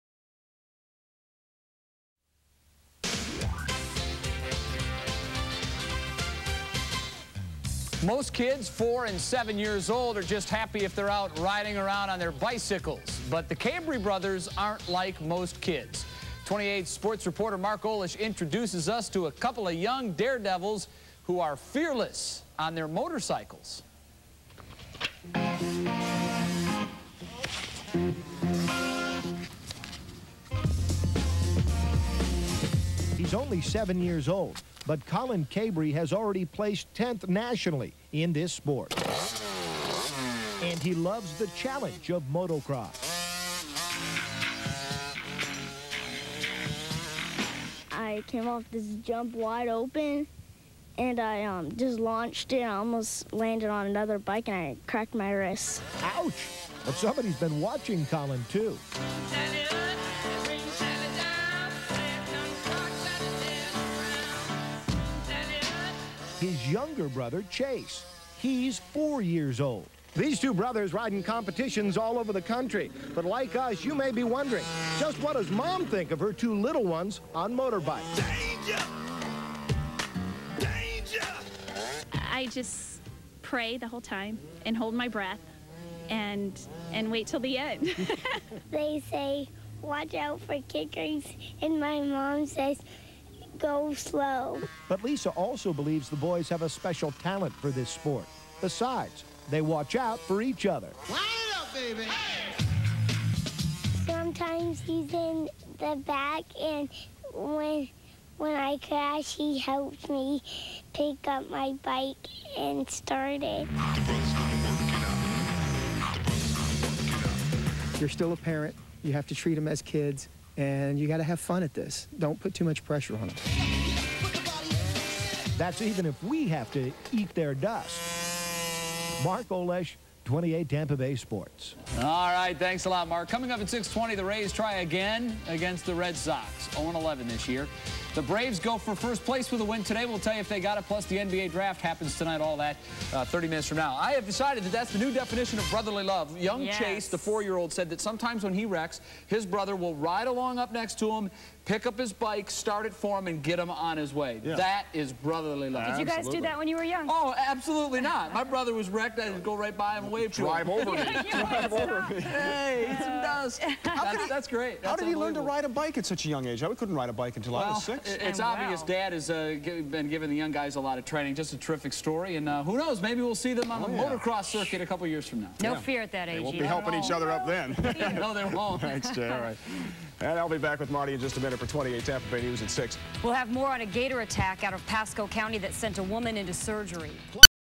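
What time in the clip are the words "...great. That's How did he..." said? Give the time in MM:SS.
02:44.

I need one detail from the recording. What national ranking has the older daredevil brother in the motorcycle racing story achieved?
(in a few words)
10th.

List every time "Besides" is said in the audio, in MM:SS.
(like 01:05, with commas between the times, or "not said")
01:38.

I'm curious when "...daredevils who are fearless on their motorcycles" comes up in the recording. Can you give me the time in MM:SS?
00:20.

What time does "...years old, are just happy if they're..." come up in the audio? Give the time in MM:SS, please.
00:09.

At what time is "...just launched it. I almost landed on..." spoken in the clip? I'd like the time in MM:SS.
00:51.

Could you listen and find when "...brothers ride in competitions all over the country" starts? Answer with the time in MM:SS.
01:10.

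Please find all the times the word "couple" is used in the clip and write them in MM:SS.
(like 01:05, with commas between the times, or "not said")
00:19, 02:54.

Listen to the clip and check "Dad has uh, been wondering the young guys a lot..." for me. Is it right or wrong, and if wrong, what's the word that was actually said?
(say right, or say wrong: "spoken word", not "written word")
wrong: "giving", not "wondering".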